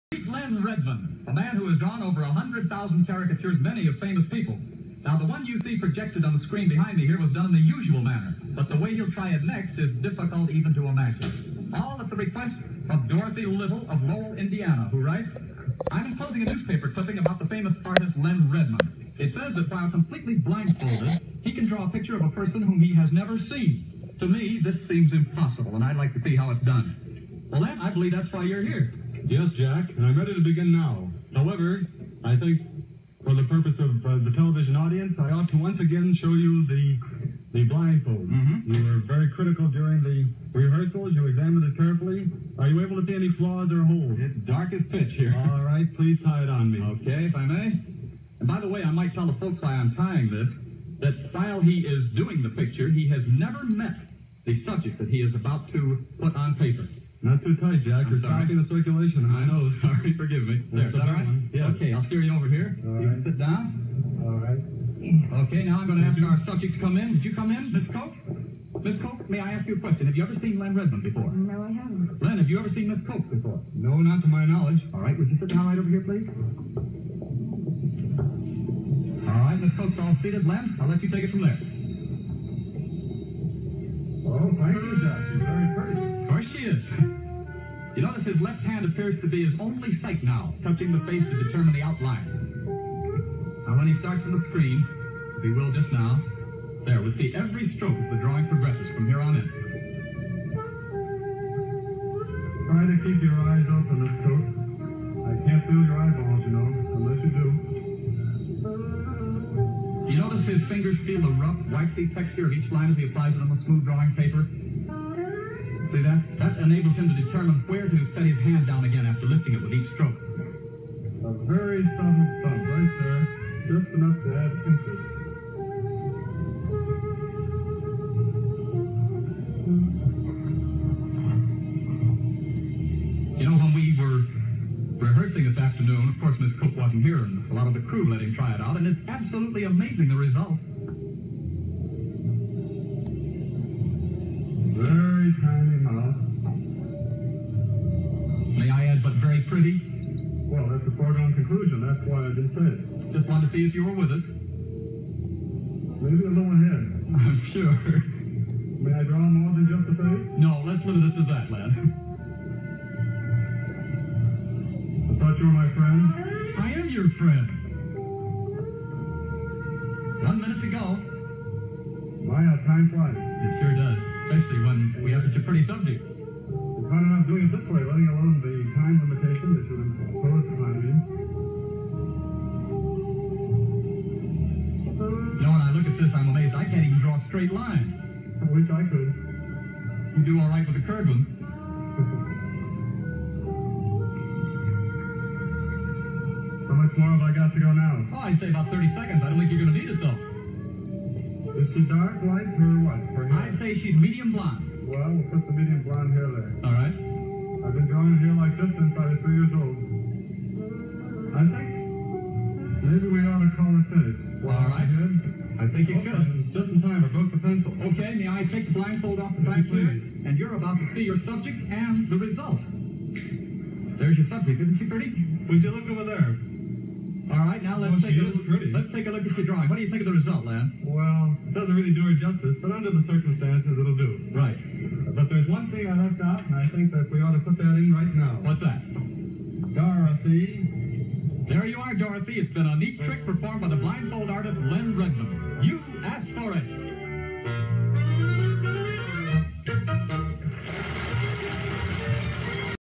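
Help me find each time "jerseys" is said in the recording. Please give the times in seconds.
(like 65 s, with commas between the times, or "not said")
not said.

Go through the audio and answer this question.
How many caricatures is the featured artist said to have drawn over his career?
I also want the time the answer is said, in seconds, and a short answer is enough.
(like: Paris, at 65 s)
over 100,000, at 2 s.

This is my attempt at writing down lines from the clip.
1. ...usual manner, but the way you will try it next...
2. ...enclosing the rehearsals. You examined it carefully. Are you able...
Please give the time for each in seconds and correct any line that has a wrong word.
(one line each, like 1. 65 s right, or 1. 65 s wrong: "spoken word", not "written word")
1. 7 s right
2. 39 s wrong: "during", not "enclosing".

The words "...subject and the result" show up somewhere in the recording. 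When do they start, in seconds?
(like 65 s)
221 s.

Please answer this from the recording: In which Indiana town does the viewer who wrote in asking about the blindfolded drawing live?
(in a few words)
Lowell.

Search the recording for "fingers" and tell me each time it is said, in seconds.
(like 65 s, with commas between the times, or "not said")
110 s.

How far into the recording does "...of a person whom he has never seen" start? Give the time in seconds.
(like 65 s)
22 s.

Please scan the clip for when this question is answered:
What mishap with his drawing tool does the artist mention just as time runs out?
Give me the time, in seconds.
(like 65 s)
217 s.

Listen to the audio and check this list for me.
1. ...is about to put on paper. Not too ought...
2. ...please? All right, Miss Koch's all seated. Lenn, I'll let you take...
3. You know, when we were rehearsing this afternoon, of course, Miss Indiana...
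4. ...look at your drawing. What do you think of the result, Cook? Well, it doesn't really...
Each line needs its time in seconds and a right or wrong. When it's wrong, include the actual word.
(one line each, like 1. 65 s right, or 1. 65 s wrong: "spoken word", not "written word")
1. 55 s wrong: "tight", not "ought"
2. 76 s right
3. 133 s wrong: "Cook", not "Indiana"
4. 229 s wrong: "Lance", not "Cook".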